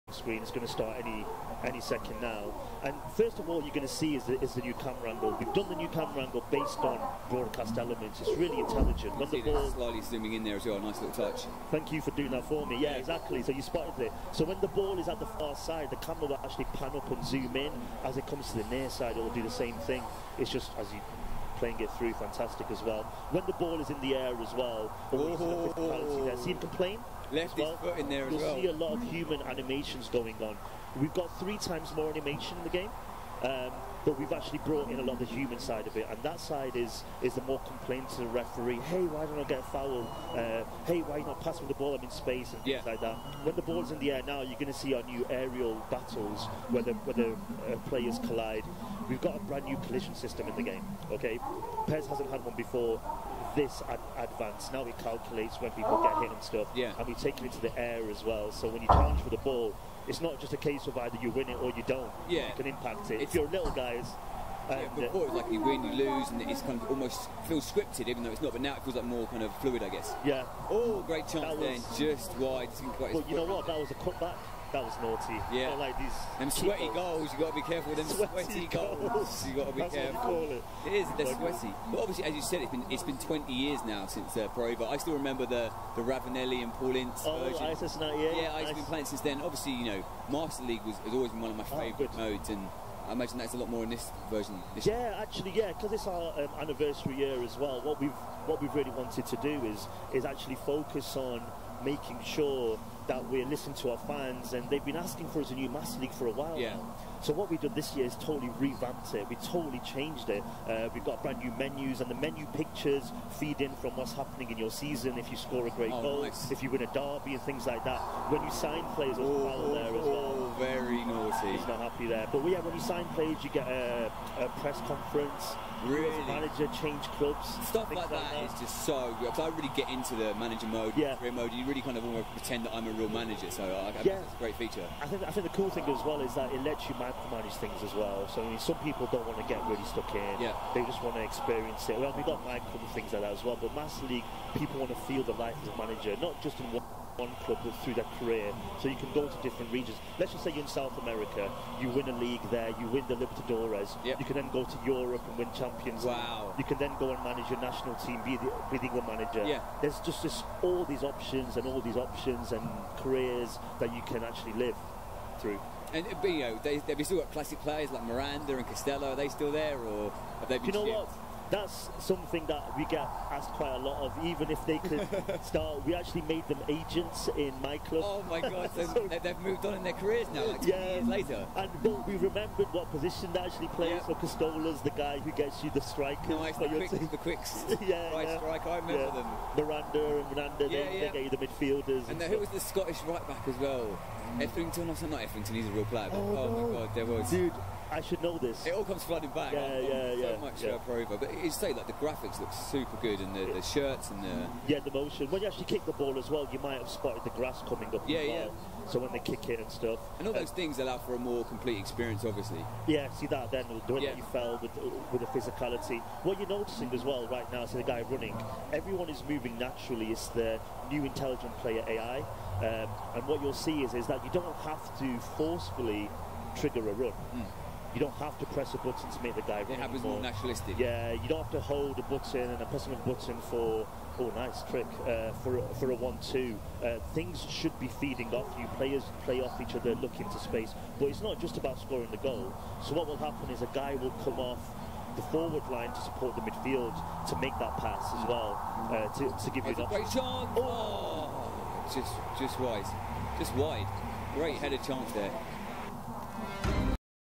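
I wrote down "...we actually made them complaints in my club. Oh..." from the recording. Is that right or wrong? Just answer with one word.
wrong.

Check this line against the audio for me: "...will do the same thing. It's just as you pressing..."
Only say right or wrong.
wrong.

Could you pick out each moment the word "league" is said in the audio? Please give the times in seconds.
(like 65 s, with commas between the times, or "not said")
90 s, 105 s, 144 s, 152 s.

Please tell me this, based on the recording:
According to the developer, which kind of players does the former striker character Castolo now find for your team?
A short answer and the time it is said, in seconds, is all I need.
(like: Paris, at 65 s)
Strikers, at 185 s.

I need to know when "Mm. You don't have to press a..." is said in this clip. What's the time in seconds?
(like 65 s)
227 s.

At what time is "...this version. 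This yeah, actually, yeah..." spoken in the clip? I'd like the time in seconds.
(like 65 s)
93 s.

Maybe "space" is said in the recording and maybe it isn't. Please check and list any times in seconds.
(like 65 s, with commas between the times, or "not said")
42 s, 240 s.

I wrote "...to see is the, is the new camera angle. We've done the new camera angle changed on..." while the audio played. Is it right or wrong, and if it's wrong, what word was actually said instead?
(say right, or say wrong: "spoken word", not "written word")
wrong: "based", not "changed".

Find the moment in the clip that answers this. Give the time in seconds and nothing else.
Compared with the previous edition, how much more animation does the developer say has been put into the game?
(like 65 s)
31 s.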